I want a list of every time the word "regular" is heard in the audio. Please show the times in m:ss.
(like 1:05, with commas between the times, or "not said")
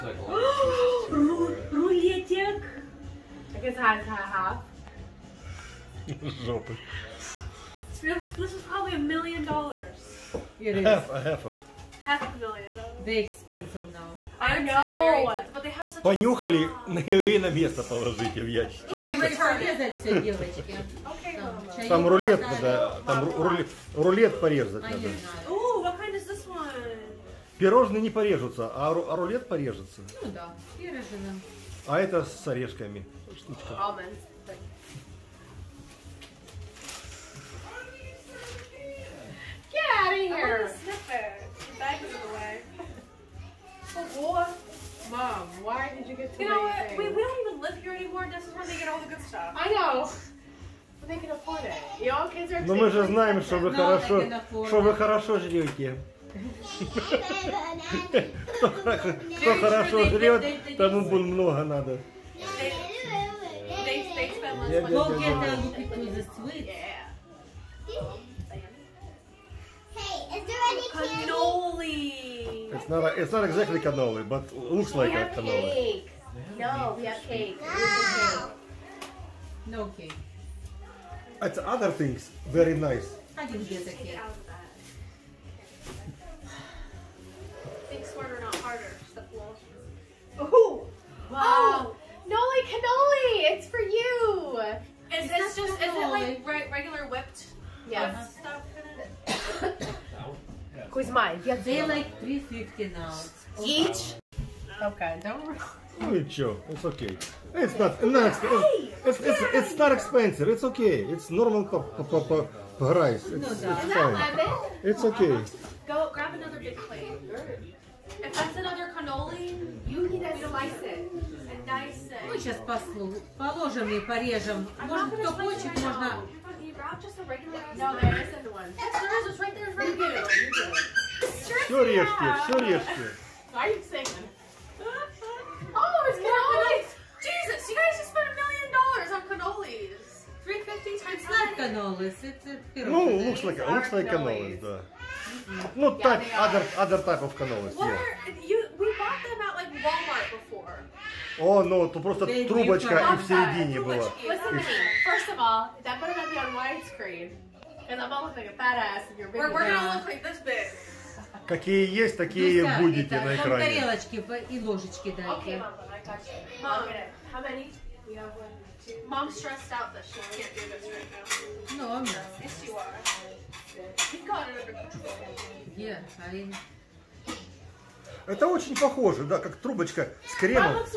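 1:36, 2:07.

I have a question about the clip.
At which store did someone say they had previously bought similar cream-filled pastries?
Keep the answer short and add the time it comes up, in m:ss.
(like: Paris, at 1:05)
Walmart, at 2:29.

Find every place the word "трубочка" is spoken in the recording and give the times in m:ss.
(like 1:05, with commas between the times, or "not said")
2:32, 2:59.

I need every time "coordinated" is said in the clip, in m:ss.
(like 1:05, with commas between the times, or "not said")
not said.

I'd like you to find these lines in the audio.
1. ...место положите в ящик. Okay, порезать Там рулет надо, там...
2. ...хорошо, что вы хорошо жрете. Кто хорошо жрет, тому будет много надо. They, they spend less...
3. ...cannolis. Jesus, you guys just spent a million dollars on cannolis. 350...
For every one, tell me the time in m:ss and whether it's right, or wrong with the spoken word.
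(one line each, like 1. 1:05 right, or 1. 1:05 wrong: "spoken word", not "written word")
1. 0:17 right
2. 0:53 right
3. 2:16 right.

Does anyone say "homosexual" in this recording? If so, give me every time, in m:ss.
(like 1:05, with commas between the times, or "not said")
not said.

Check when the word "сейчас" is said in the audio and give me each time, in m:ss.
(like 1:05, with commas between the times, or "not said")
2:02.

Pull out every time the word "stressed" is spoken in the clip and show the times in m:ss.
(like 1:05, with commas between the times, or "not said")
2:49.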